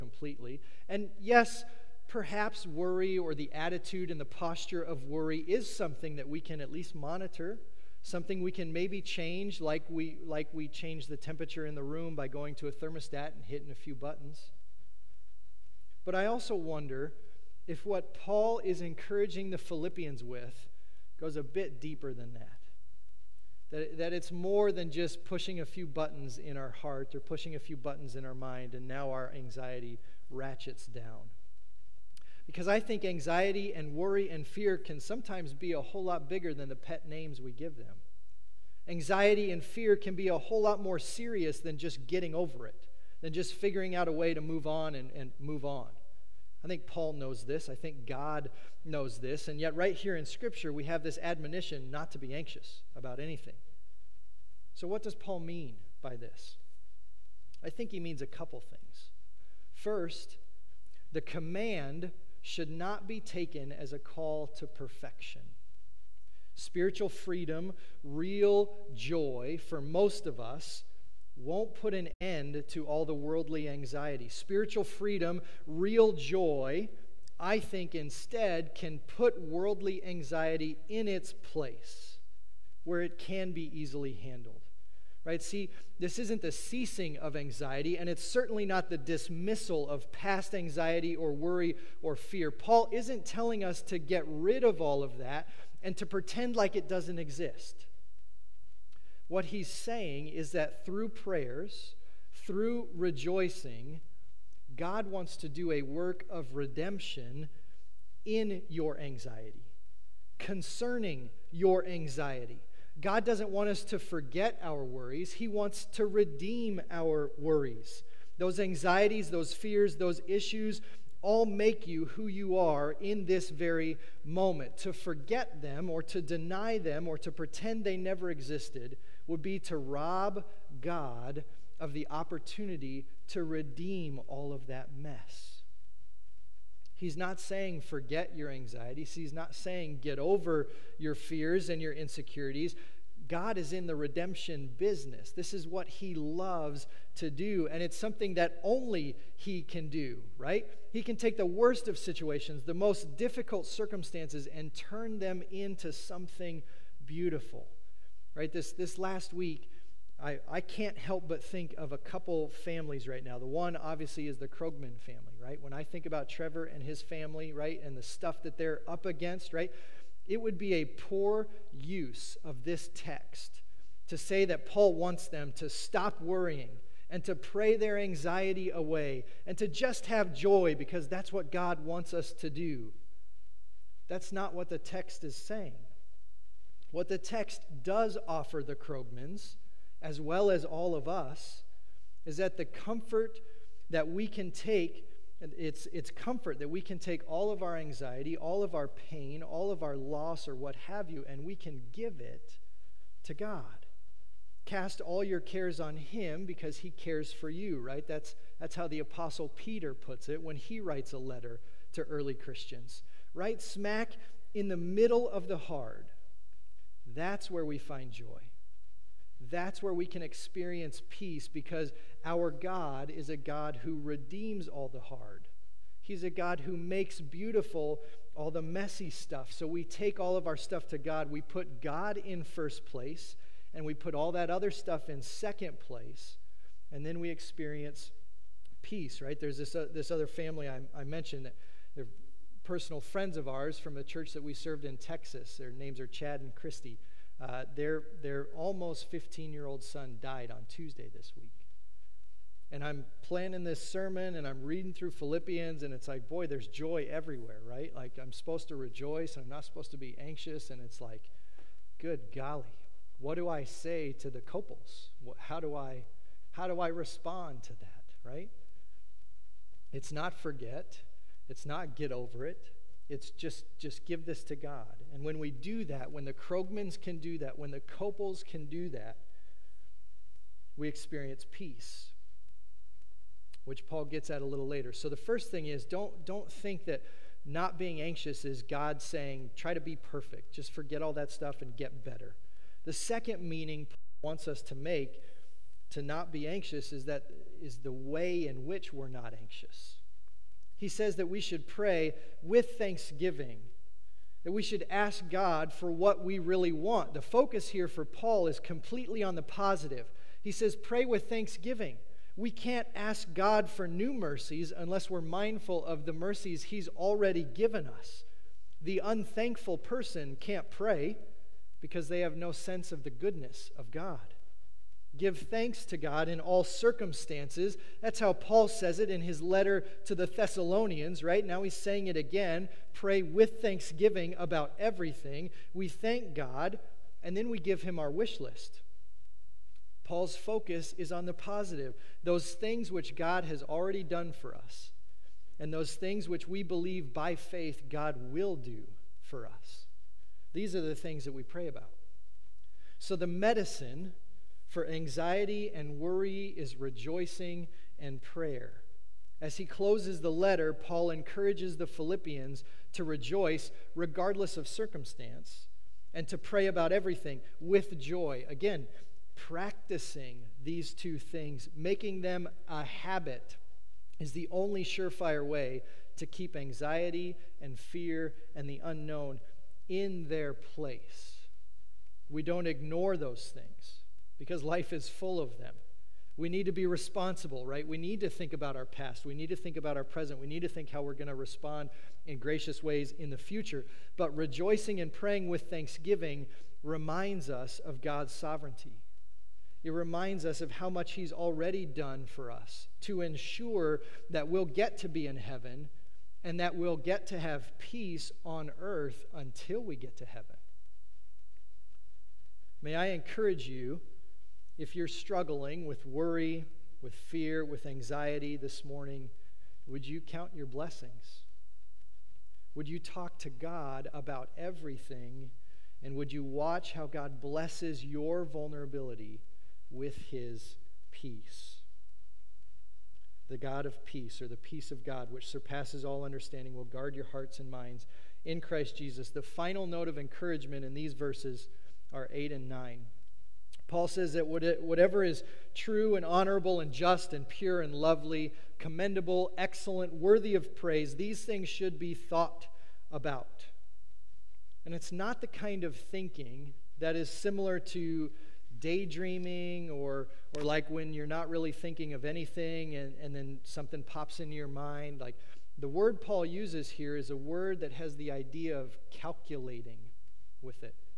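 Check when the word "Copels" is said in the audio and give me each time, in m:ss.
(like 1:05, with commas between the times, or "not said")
4:37.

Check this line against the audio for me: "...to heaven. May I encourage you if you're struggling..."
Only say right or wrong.
right.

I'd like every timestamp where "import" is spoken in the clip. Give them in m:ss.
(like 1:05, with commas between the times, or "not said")
not said.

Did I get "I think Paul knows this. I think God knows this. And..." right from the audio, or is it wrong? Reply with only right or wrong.
right.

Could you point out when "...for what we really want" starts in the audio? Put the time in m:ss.
5:05.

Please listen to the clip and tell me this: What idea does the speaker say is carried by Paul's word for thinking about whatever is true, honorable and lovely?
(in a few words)
calculating.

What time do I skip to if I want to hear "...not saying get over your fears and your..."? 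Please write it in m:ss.
2:19.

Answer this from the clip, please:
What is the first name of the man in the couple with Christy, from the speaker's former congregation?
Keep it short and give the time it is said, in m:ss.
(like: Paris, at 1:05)
Chad, at 4:06.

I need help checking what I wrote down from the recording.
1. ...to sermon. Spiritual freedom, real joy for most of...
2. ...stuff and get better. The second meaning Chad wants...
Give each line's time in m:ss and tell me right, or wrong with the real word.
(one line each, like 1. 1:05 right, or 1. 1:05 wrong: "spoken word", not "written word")
1. 1:04 wrong: "perfection", not "sermon"
2. 4:51 wrong: "Paul", not "Chad".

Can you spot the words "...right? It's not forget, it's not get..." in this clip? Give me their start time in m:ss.
4:28.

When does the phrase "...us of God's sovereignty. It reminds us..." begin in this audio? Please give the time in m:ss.
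6:37.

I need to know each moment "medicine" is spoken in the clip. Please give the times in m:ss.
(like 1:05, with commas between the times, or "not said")
5:53.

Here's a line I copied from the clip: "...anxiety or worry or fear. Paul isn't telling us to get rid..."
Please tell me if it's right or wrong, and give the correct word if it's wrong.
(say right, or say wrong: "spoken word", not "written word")
right.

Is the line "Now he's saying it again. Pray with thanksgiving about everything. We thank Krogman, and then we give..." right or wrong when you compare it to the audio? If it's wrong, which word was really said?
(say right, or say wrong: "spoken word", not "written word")
wrong: "God", not "Krogman".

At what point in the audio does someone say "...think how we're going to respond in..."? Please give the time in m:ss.
6:30.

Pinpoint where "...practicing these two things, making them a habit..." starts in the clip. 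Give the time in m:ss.
6:09.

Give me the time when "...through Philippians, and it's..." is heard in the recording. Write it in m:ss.
4:14.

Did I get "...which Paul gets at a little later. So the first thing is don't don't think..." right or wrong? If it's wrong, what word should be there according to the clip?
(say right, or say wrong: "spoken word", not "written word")
right.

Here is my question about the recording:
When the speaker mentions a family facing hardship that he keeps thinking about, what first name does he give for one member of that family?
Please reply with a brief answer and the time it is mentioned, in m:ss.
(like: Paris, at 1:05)
Trevor, at 2:46.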